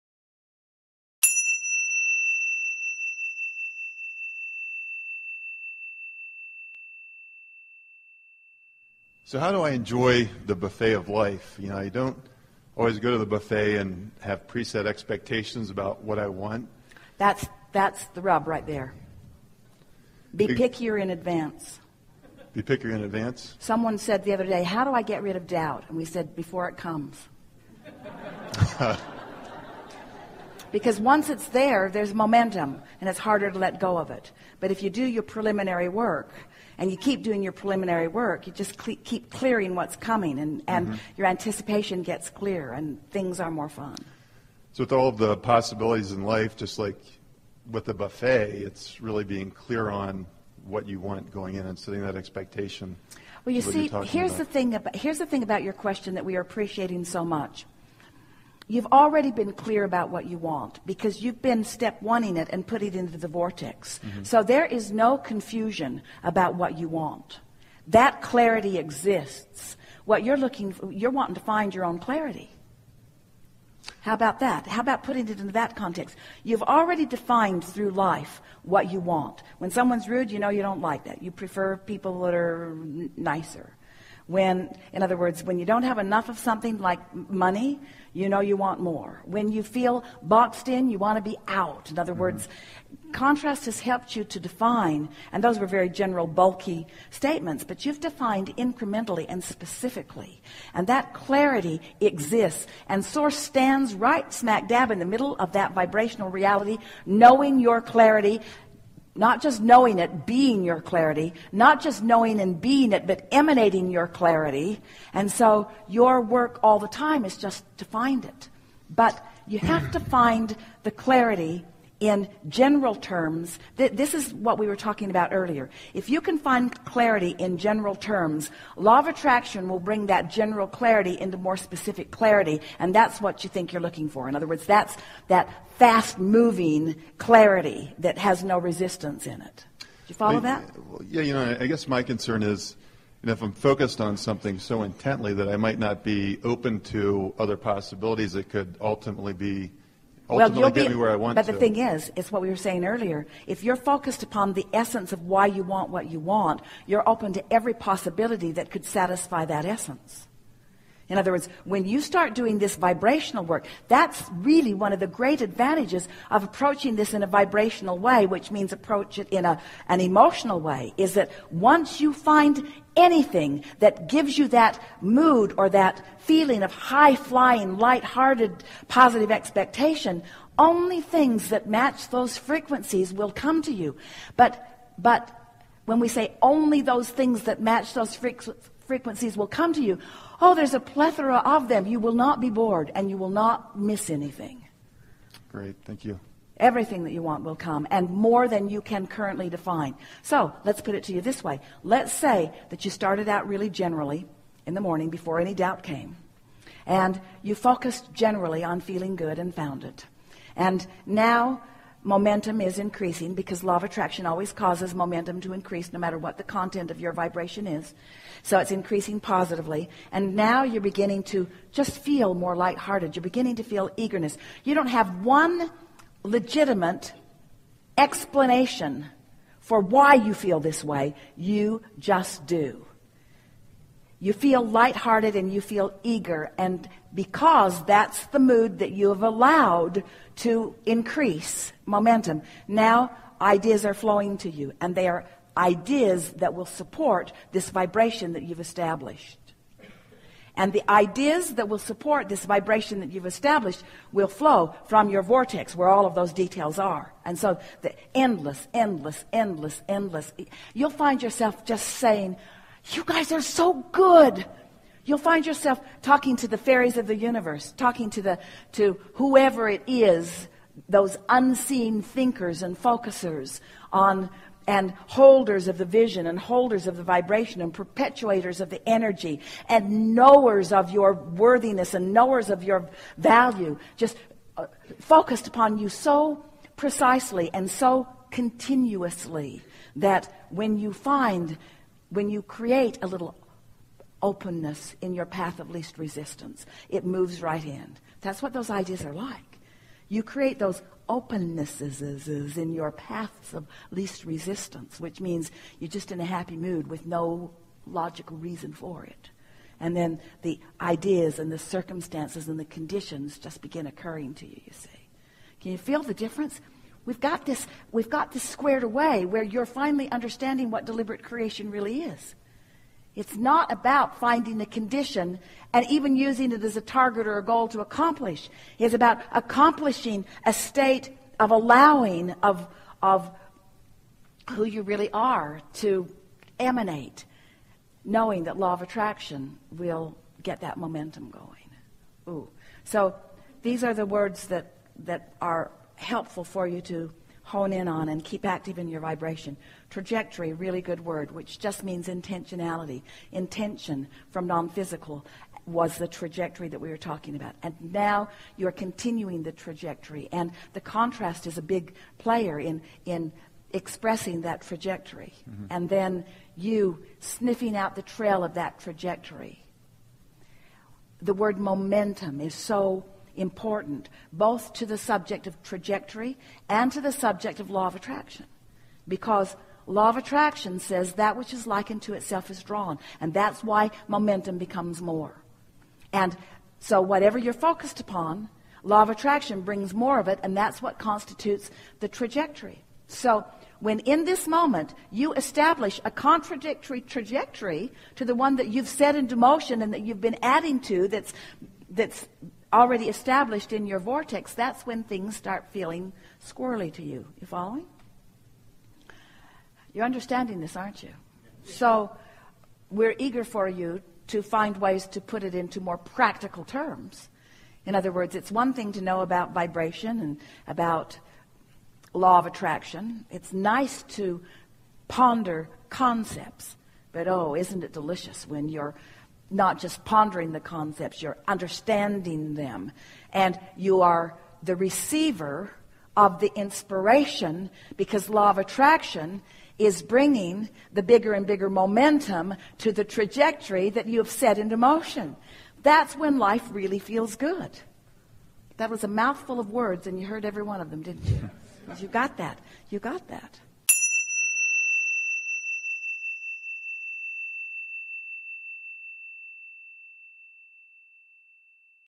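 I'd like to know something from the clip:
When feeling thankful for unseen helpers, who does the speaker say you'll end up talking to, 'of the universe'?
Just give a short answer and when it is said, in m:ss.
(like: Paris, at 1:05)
the fairies, at 4:26.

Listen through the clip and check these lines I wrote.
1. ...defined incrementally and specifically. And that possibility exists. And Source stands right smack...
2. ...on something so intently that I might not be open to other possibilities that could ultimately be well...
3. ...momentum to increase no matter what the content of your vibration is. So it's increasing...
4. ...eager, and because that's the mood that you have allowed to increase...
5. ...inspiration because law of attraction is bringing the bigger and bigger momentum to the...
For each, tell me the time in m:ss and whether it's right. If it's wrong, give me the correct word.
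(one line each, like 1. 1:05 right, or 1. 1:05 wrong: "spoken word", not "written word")
1. 1:37 wrong: "clarity", not "possibility"
2. 2:24 right
3. 3:34 right
4. 3:56 right
5. 7:16 right.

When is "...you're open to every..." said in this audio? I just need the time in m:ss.
2:36.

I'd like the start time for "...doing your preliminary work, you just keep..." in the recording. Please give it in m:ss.
0:37.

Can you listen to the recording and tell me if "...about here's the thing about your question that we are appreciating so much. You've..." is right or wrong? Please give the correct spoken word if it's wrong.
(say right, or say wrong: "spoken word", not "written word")
right.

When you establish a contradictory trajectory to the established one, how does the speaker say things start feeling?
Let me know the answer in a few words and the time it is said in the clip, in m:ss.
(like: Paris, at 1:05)
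squirrely, at 6:46.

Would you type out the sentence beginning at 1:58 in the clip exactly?
But you have to find the clarity in general terms, th- this is what we were talking about earlier.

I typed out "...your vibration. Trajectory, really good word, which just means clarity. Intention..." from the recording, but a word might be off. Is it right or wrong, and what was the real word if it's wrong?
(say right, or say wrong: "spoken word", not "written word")
wrong: "intentionality", not "clarity".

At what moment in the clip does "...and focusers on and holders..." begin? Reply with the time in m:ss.
4:32.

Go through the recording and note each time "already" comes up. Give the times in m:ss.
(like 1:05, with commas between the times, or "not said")
0:58, 1:16, 6:42.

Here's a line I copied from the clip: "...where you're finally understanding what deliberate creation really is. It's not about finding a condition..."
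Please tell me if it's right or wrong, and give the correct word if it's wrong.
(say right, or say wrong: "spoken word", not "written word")
right.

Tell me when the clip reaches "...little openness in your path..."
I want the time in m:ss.
4:53.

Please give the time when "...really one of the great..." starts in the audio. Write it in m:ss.
2:44.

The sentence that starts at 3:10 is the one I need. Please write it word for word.
Oh, there's a plethora of them.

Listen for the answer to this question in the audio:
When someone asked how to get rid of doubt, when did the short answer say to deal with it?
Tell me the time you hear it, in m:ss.
0:26.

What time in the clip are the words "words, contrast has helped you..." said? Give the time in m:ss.
1:32.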